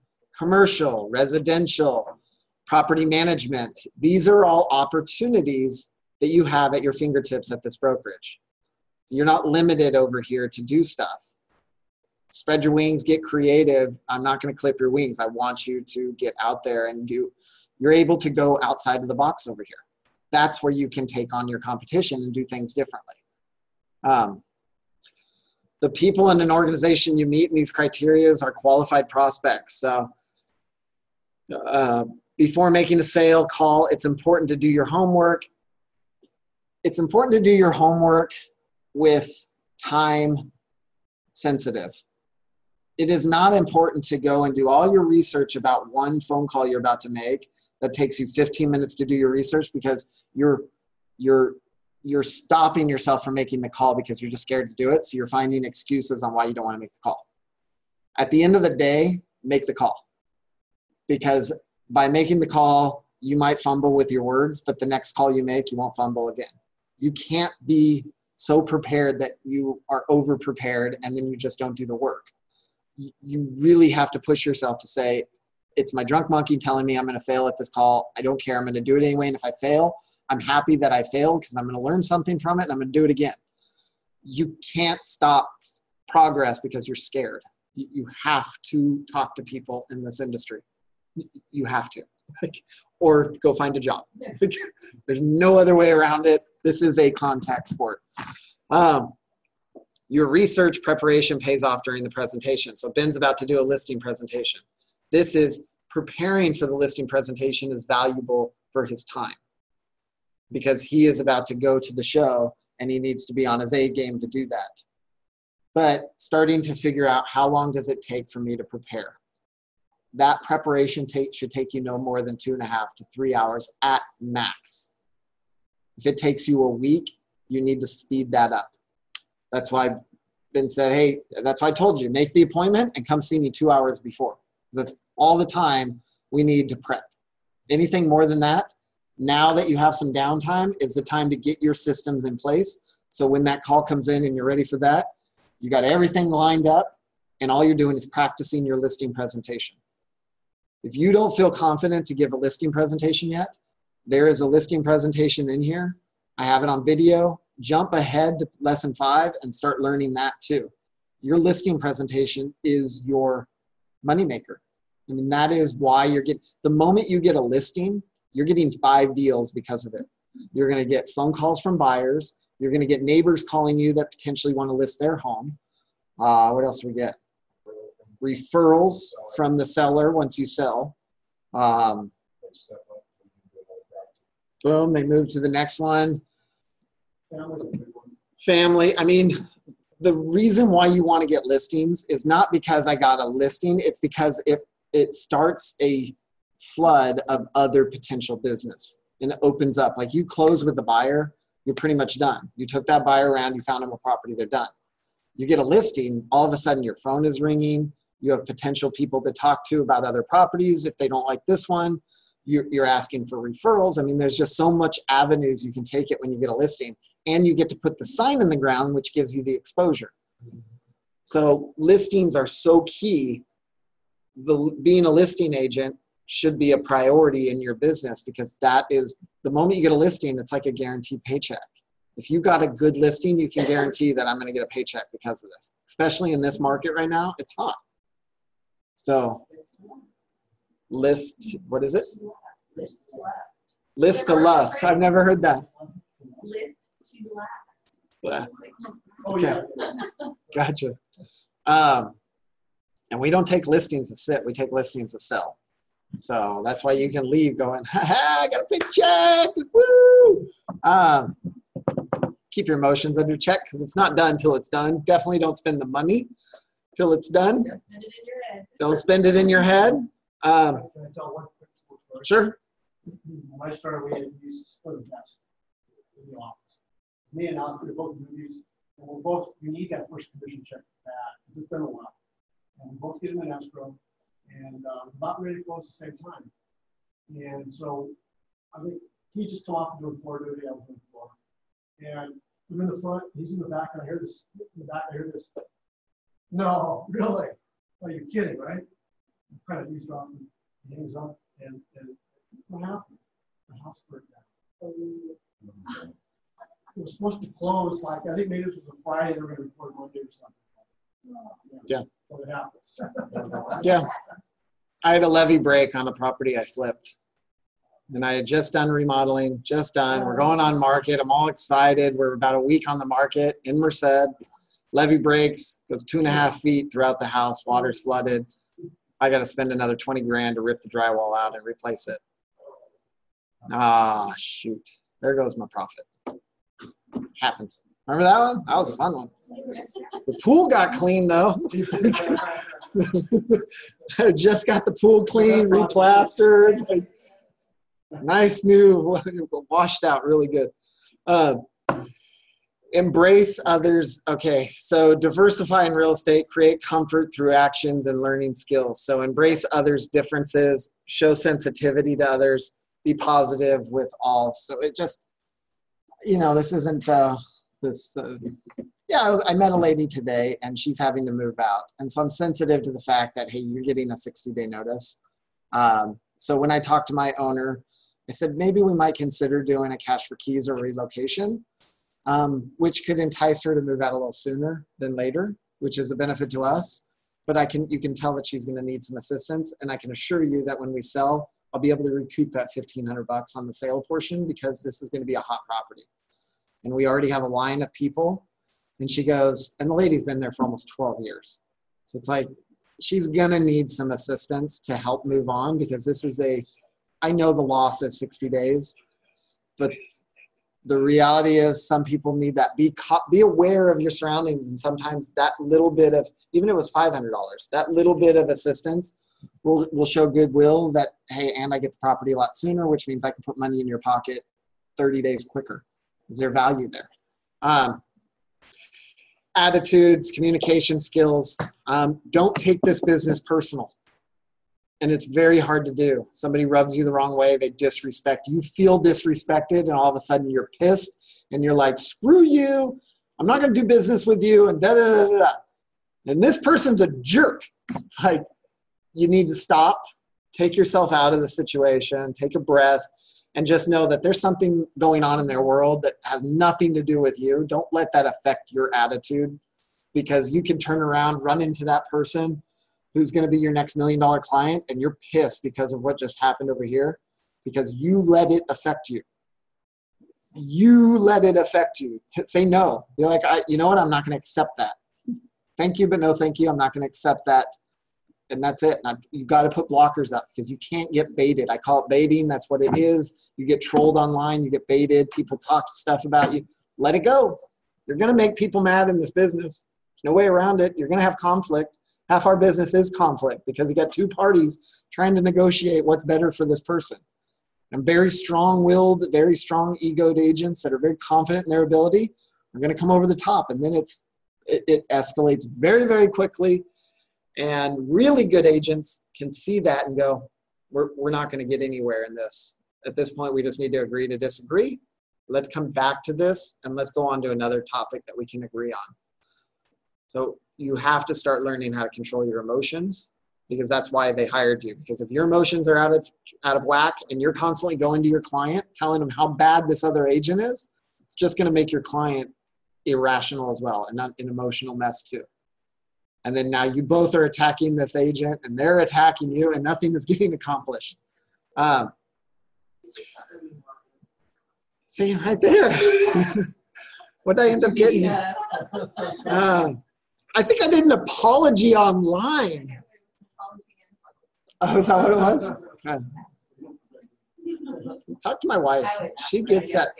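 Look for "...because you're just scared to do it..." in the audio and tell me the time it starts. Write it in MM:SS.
00:53.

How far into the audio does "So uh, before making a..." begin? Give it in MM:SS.
00:29.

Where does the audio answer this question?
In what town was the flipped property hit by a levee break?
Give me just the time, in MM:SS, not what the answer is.
05:23.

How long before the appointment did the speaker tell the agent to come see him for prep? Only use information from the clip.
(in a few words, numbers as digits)
2 hours.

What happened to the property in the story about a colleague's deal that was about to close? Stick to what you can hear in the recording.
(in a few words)
The house burned down.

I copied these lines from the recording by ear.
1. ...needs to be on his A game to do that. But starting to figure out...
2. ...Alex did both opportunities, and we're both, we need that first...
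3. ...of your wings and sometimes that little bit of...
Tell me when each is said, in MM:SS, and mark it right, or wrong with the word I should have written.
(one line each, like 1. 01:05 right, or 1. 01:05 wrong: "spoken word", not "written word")
1. 01:52 right
2. 04:37 wrong: "movies", not "opportunities"
3. 06:53 wrong: "surroundings", not "wings".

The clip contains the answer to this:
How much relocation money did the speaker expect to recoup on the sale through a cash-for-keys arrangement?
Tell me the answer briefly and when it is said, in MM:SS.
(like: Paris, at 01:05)
$1,500, at 06:32.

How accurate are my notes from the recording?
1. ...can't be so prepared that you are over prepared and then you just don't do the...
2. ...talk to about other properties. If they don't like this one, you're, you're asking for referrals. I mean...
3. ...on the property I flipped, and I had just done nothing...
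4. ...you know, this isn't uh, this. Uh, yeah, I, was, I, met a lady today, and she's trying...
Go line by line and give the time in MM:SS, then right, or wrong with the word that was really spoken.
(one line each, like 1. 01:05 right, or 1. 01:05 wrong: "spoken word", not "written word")
1. 01:07 right
2. 03:29 right
3. 05:15 wrong: "remodeling", not "nothing"
4. 06:06 wrong: "having", not "trying".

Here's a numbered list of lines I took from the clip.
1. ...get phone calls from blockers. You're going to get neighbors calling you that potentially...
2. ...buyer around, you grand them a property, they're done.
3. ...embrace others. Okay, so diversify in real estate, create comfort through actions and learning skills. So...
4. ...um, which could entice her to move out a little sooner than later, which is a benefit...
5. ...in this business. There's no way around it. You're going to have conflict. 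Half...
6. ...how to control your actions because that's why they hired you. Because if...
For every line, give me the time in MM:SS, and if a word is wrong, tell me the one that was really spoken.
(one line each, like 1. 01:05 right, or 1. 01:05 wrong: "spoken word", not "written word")
1. 02:50 wrong: "buyers", not "blockers"
2. 03:23 wrong: "found", not "grand"
3. 05:52 right
4. 06:22 right
5. 08:09 right
6. 08:41 wrong: "emotions", not "actions".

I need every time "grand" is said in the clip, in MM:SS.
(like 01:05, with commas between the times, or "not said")
05:30.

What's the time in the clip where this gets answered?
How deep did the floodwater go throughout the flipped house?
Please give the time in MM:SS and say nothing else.
05:26.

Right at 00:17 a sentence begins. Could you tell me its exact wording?
You're able to go outside of the box over here.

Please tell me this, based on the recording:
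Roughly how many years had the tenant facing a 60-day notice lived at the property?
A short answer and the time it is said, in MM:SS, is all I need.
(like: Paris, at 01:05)
12, at 06:40.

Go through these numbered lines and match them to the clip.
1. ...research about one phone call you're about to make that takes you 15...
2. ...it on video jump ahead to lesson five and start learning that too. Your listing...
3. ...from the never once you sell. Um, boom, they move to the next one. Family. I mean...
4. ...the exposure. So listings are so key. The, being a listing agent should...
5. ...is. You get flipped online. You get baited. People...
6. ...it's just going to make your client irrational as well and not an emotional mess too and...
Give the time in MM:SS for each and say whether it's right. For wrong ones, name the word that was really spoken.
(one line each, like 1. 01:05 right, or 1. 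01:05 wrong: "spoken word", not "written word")
1. 00:45 right
2. 02:36 right
3. 02:59 wrong: "seller", not "never"
4. 03:39 right
5. 08:02 wrong: "trolled", not "flipped"
6. 08:51 right.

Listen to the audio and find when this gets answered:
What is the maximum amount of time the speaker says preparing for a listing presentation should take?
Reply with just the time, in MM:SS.
02:02.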